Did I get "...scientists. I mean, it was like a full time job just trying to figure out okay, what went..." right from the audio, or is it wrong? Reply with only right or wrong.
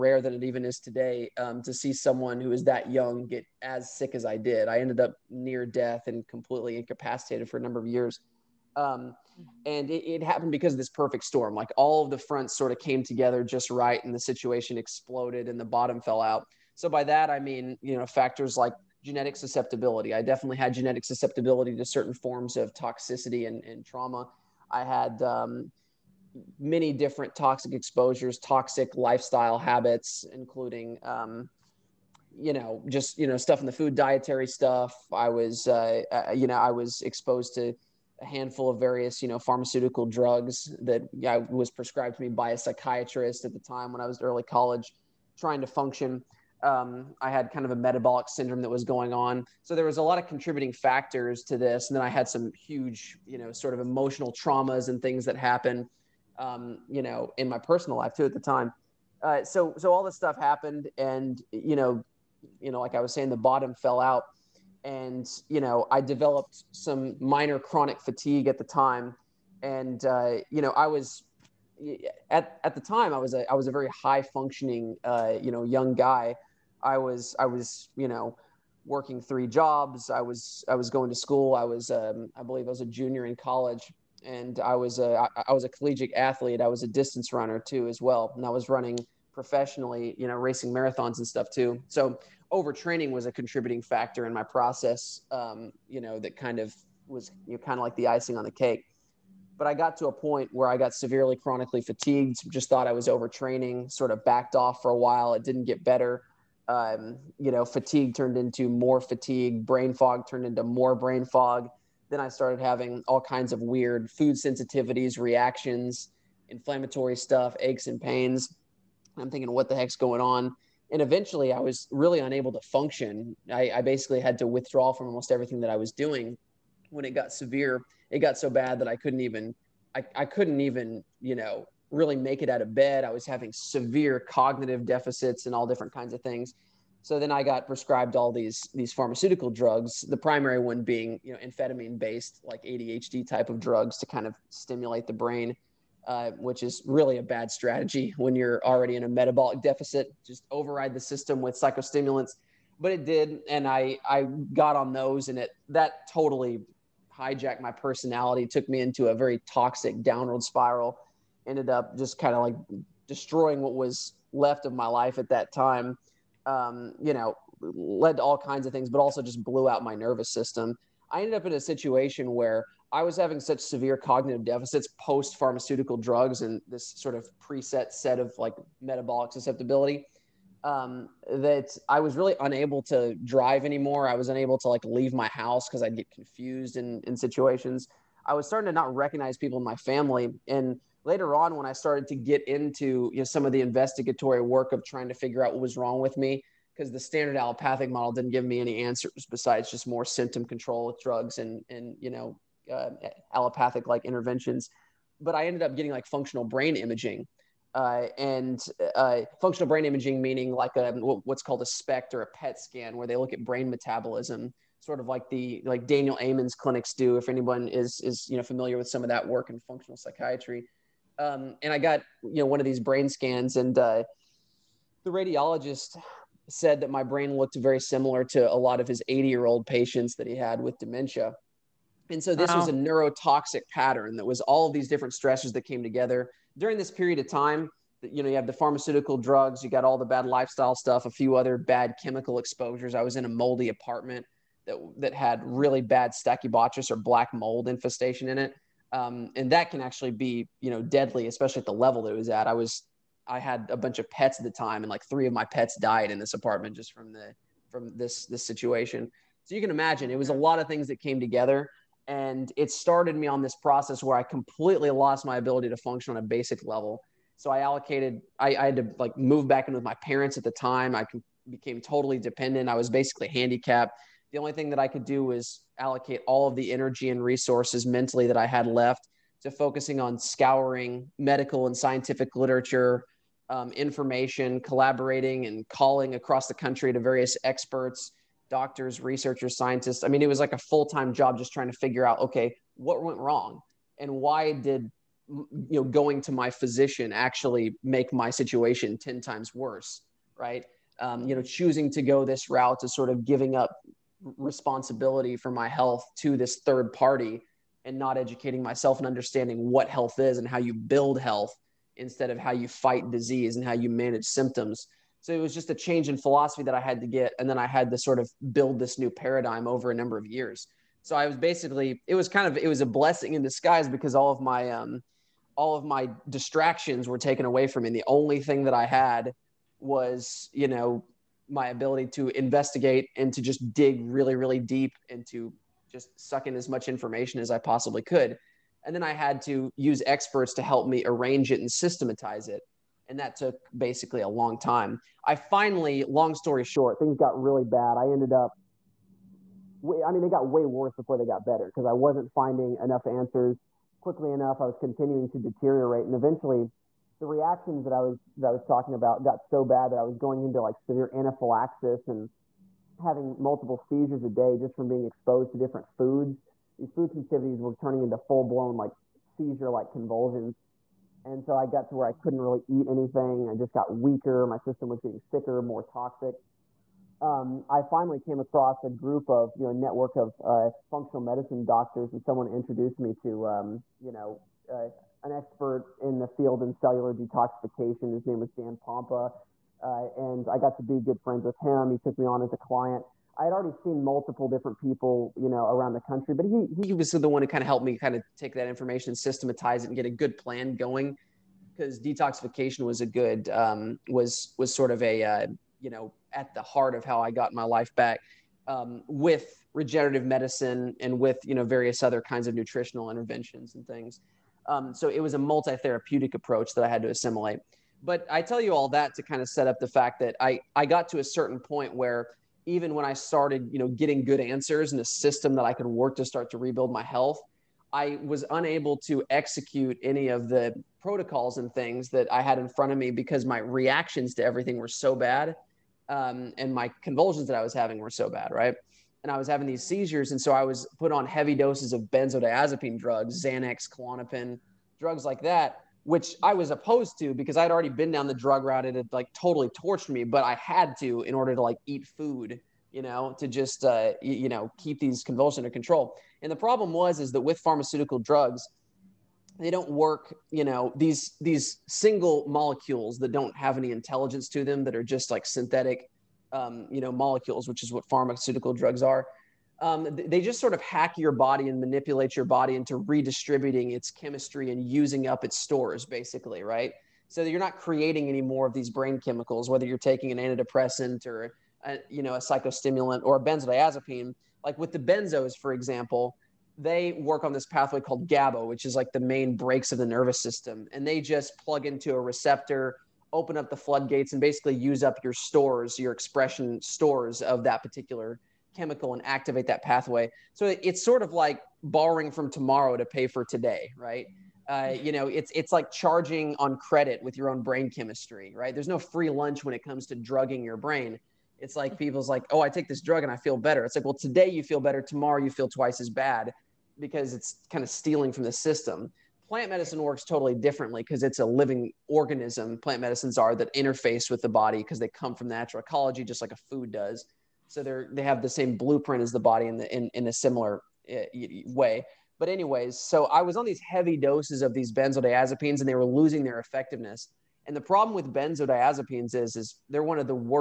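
right.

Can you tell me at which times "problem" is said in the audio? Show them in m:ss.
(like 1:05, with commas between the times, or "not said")
7:36, 8:57.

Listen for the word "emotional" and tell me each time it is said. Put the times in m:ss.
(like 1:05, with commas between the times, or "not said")
0:53.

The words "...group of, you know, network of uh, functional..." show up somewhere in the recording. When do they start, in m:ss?
6:18.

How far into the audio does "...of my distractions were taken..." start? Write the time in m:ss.
5:25.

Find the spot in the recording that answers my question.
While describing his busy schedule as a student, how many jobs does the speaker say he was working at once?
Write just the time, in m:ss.
1:19.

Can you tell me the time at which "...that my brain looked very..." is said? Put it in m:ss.
3:46.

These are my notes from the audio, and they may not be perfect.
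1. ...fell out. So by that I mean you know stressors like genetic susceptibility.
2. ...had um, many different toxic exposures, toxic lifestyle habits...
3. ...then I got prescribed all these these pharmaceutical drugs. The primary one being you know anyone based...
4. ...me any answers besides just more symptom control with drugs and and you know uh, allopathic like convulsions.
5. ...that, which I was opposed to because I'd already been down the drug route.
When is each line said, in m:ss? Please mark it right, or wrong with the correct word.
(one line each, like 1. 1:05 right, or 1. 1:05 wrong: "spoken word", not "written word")
1. 0:16 wrong: "factors", not "stressors"
2. 0:24 right
3. 2:17 wrong: "amphetamine", not "anyone"
4. 3:18 wrong: "interventions", not "convulsions"
5. 7:25 right.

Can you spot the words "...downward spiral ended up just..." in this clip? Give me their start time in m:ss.
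2:40.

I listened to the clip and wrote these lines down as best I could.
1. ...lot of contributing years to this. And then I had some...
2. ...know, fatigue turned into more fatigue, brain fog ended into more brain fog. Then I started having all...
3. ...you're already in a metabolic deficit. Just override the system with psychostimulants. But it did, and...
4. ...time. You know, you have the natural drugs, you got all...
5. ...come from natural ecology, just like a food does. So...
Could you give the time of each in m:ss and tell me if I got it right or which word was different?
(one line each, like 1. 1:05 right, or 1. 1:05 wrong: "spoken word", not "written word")
1. 0:50 wrong: "factors", not "years"
2. 1:47 wrong: "turned", not "ended"
3. 2:28 right
4. 3:57 wrong: "pharmaceutical", not "natural"
5. 8:45 right.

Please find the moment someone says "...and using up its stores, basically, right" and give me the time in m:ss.
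7:54.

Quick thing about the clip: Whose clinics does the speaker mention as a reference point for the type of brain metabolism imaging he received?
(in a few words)
Daniel Amen's.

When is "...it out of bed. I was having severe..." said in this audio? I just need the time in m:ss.
2:12.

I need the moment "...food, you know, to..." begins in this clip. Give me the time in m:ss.
7:32.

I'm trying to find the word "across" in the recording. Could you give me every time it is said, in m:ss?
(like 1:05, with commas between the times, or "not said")
4:46, 6:18.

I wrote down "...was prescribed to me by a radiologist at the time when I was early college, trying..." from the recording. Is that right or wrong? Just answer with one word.
wrong.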